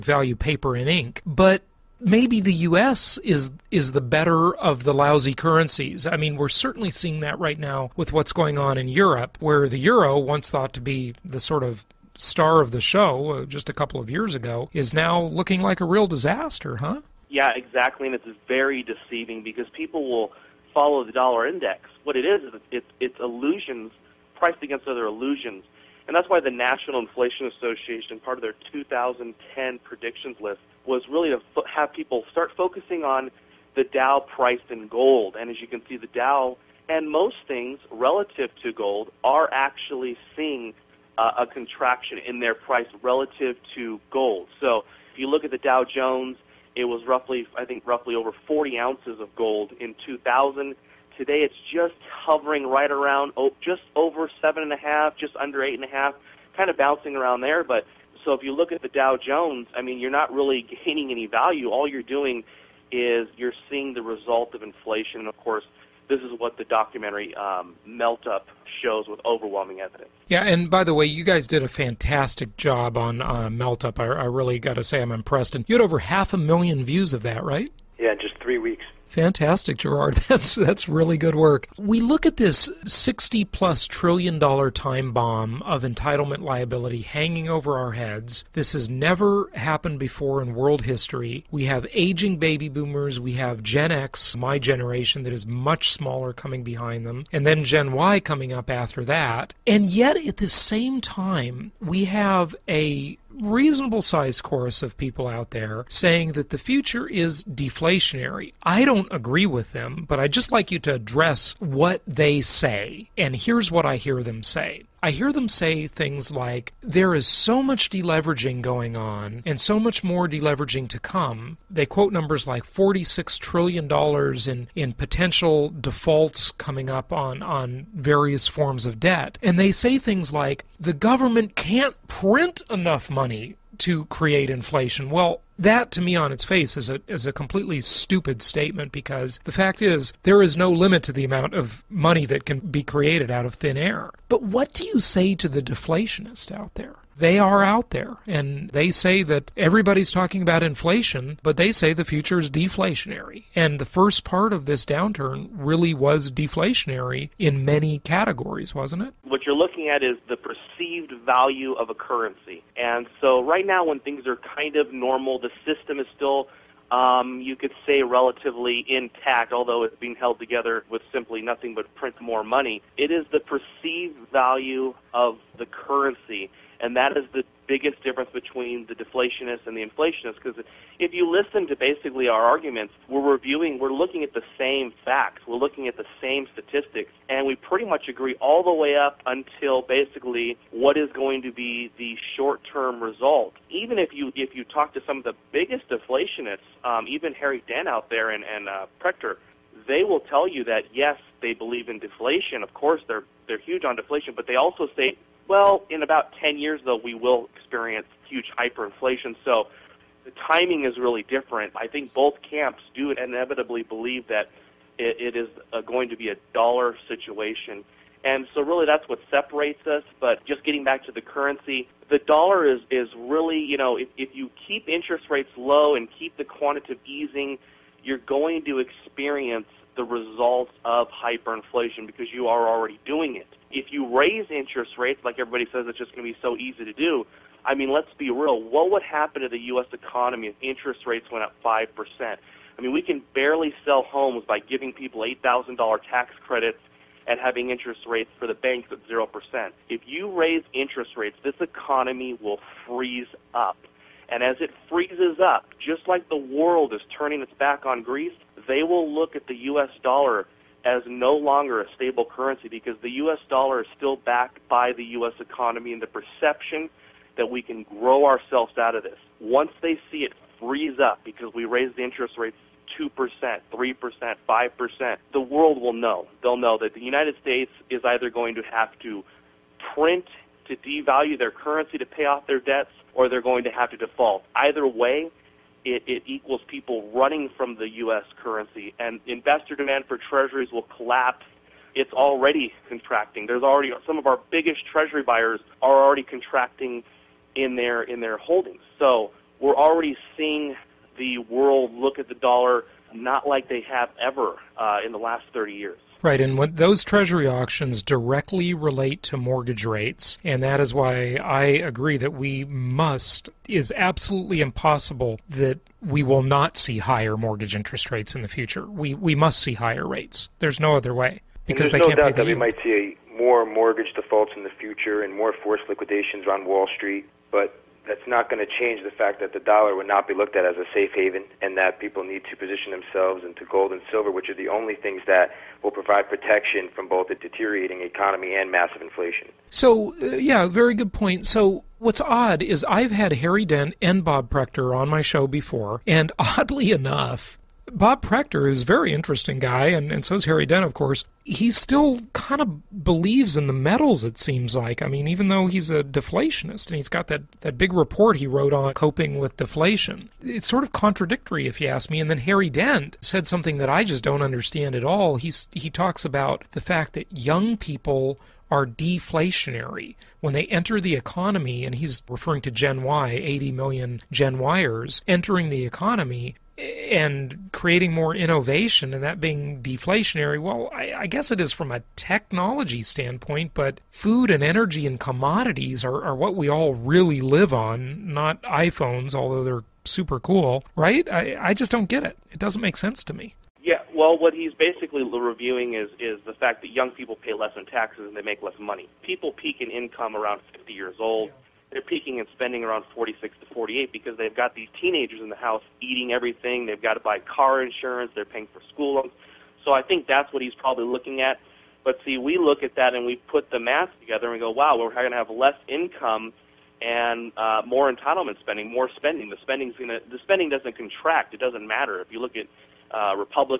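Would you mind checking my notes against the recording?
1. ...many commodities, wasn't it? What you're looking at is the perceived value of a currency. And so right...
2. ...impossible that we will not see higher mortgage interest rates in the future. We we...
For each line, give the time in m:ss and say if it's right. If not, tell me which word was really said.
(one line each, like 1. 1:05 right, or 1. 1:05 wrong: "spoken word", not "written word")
1. 2:37 wrong: "categories", not "commodities"
2. 5:14 right.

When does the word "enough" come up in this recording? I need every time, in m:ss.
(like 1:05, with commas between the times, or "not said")
2:12, 5:46.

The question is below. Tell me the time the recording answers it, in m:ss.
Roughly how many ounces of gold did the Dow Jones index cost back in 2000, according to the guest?
0:48.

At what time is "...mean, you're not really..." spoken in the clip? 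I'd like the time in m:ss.
0:59.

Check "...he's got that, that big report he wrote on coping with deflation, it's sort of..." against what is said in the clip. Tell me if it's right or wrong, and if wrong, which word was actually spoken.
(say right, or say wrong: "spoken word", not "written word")
right.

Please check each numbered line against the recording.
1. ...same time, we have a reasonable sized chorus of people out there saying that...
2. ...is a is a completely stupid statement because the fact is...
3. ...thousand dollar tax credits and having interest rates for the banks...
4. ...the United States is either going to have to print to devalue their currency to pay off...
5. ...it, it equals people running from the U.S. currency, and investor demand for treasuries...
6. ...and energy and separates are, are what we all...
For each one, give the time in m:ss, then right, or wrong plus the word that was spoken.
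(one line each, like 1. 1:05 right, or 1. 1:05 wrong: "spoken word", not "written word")
1. 1:40 right
2. 2:16 right
3. 4:05 right
4. 4:36 right
5. 4:45 right
6. 6:24 wrong: "commodities", not "separates".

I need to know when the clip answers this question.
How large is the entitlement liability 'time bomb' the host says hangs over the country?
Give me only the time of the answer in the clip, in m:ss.
1:22.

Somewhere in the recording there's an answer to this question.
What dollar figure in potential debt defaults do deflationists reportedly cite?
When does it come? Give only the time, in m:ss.
2:02.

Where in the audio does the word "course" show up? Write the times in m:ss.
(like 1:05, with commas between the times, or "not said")
1:05, 3:22, 5:50.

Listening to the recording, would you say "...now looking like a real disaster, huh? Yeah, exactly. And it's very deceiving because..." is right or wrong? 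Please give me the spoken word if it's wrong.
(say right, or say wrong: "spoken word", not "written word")
right.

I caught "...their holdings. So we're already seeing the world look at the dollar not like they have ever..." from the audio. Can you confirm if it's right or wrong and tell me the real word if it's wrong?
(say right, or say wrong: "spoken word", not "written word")
right.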